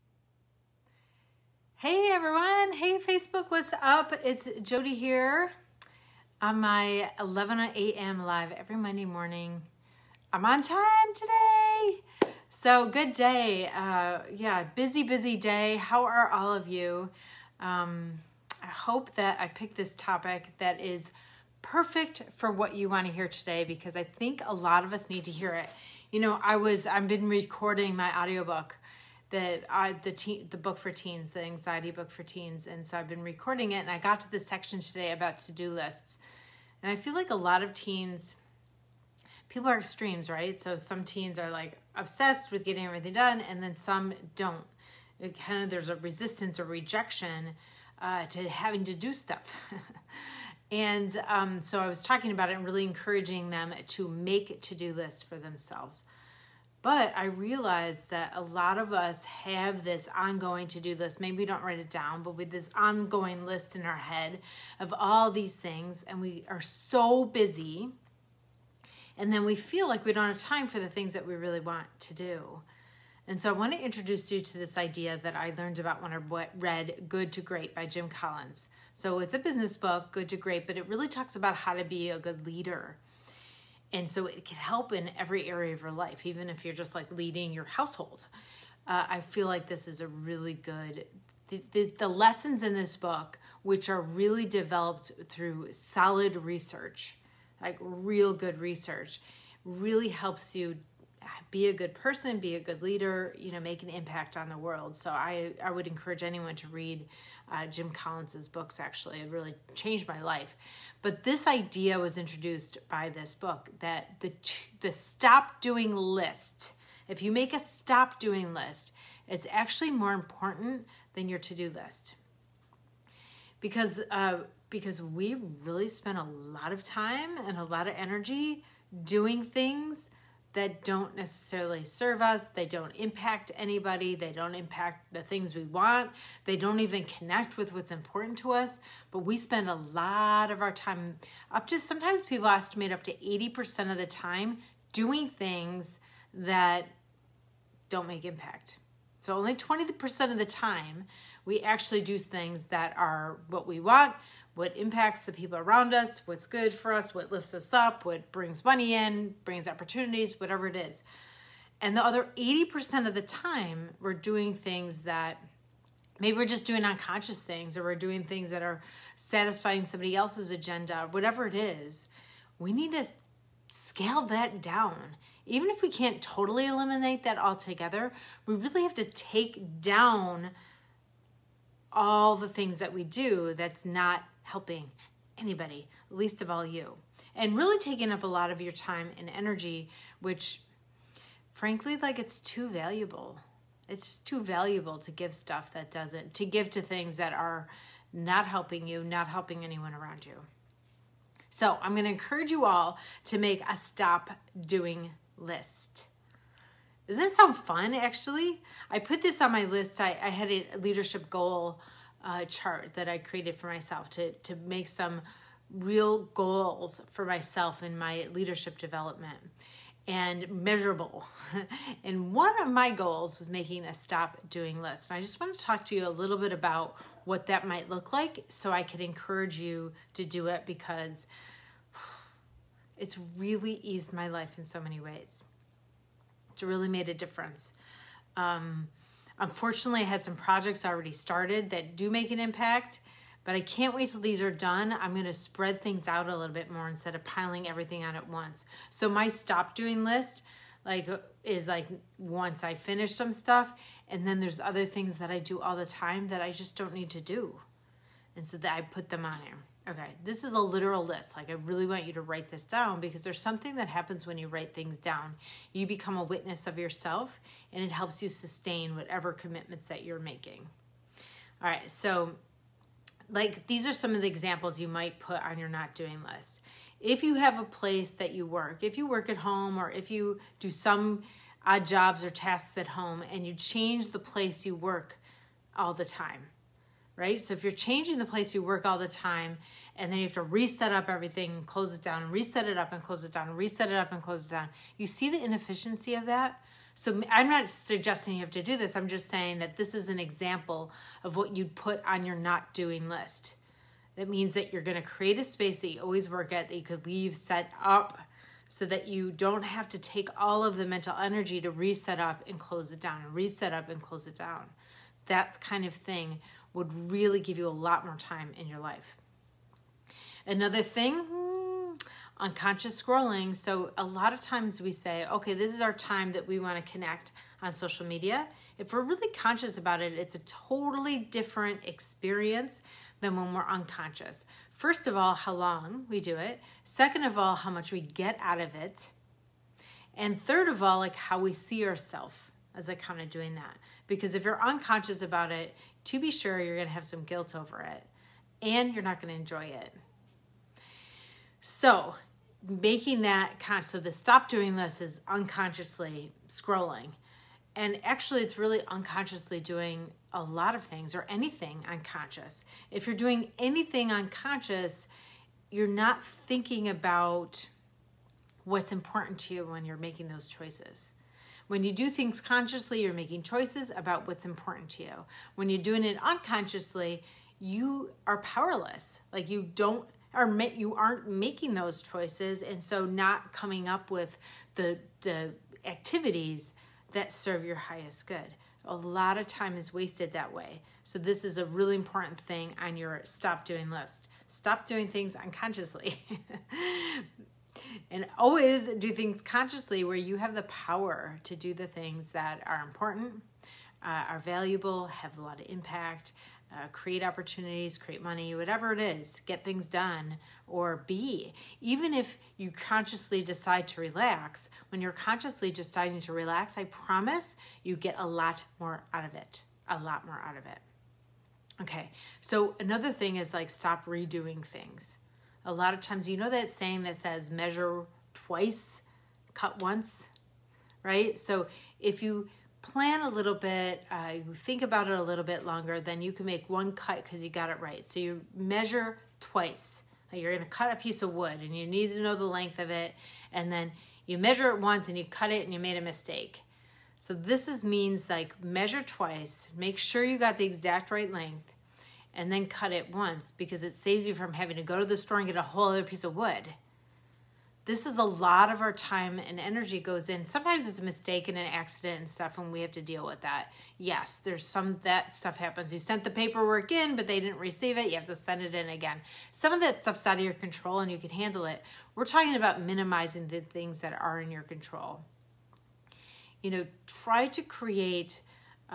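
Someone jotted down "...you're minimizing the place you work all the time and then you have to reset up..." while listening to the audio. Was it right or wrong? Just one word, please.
wrong.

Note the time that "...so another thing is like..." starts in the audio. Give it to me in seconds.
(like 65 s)
422 s.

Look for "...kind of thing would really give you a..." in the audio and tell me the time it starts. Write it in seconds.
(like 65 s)
315 s.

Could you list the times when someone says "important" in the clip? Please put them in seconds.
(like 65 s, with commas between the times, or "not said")
120 s, 137 s, 368 s, 374 s, 391 s, 402 s.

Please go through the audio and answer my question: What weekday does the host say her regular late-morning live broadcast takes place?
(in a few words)
Monday.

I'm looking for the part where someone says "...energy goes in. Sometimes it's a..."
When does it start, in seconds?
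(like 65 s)
459 s.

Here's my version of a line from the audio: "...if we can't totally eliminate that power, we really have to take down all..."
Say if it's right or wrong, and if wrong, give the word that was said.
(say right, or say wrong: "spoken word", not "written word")
wrong: "altogether", not "power".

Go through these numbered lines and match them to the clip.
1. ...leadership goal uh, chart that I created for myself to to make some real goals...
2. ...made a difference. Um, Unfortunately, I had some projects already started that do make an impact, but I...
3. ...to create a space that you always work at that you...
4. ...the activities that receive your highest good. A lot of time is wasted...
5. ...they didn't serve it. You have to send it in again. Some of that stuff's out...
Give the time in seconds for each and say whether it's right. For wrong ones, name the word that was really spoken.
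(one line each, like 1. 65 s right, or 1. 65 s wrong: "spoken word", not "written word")
1. 210 s right
2. 236 s right
3. 304 s right
4. 385 s wrong: "serve", not "receive"
5. 467 s wrong: "receive", not "serve".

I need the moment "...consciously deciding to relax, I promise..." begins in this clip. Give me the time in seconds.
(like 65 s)
415 s.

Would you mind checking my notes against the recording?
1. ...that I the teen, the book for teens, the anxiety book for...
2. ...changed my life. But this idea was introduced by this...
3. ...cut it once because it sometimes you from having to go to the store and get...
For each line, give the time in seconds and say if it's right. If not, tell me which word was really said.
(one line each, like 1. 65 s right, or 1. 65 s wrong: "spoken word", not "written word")
1. 29 s right
2. 109 s right
3. 452 s wrong: "saves", not "sometimes".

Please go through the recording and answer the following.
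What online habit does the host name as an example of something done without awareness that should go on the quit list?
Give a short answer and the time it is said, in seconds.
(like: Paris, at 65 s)
unconscious scrolling, at 322 s.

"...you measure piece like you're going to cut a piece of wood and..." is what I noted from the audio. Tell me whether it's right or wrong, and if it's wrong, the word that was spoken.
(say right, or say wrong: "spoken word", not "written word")
wrong: "twice", not "piece".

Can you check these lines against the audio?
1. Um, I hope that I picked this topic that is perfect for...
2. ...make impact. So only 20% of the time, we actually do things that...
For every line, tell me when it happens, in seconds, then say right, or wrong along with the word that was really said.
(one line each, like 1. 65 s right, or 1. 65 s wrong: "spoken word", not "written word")
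1. 17 s right
2. 148 s right.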